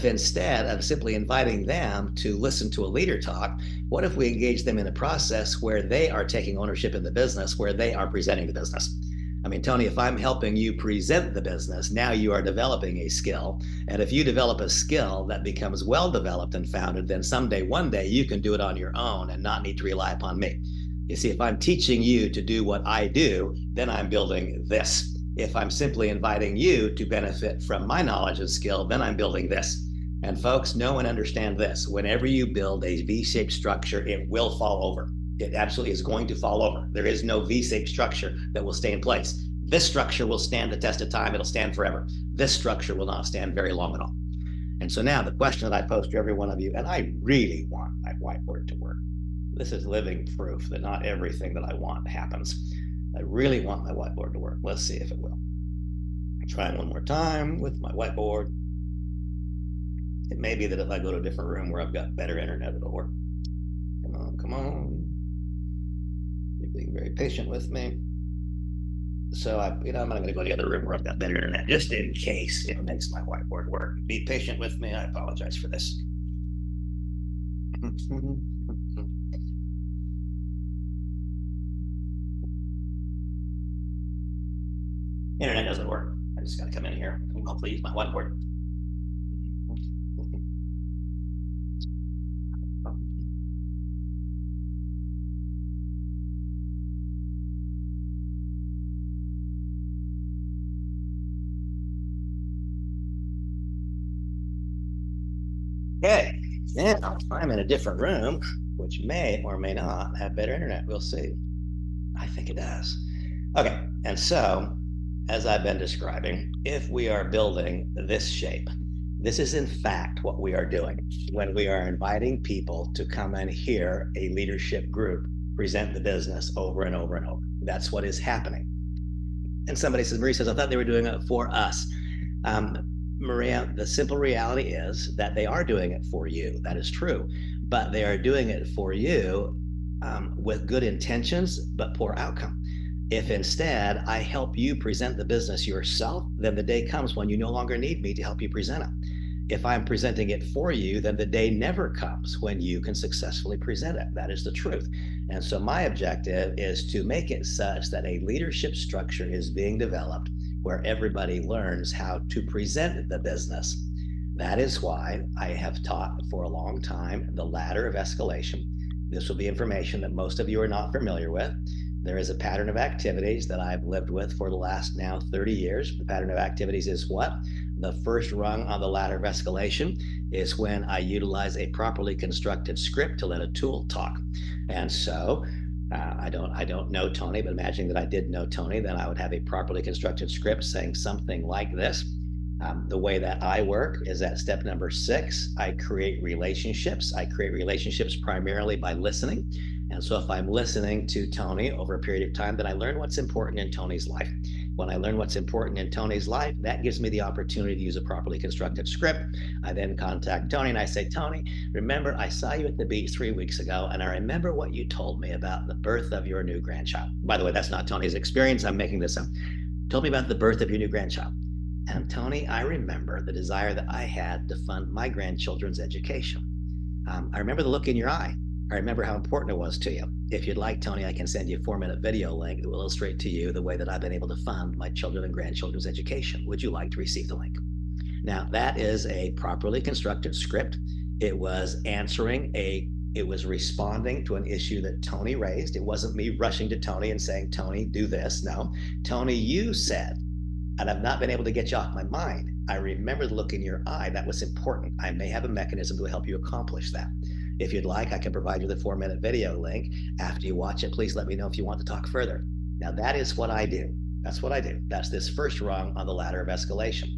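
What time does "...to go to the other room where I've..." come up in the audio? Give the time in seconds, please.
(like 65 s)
70 s.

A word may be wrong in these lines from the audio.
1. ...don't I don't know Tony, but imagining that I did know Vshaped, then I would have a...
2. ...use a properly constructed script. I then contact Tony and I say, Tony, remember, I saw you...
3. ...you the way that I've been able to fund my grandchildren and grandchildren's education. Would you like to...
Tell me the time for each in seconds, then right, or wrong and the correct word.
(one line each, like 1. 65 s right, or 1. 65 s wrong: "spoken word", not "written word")
1. 186 s wrong: "Tony", not "Vshaped"
2. 207 s right
3. 233 s wrong: "children", not "grandchildren".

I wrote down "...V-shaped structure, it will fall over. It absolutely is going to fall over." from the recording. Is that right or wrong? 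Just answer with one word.
right.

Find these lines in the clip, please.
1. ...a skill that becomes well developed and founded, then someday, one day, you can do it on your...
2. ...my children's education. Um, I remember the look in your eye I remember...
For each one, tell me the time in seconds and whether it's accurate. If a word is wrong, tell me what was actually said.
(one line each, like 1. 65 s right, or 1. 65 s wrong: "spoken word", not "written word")
1. 14 s right
2. 224 s wrong: "grandchildren", not "children".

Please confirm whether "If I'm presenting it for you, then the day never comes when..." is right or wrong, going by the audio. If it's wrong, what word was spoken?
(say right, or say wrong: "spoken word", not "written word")
right.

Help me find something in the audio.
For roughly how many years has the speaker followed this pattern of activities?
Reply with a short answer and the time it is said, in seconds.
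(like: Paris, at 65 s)
30 years, at 175 s.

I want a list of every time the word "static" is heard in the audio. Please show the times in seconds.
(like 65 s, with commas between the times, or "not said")
not said.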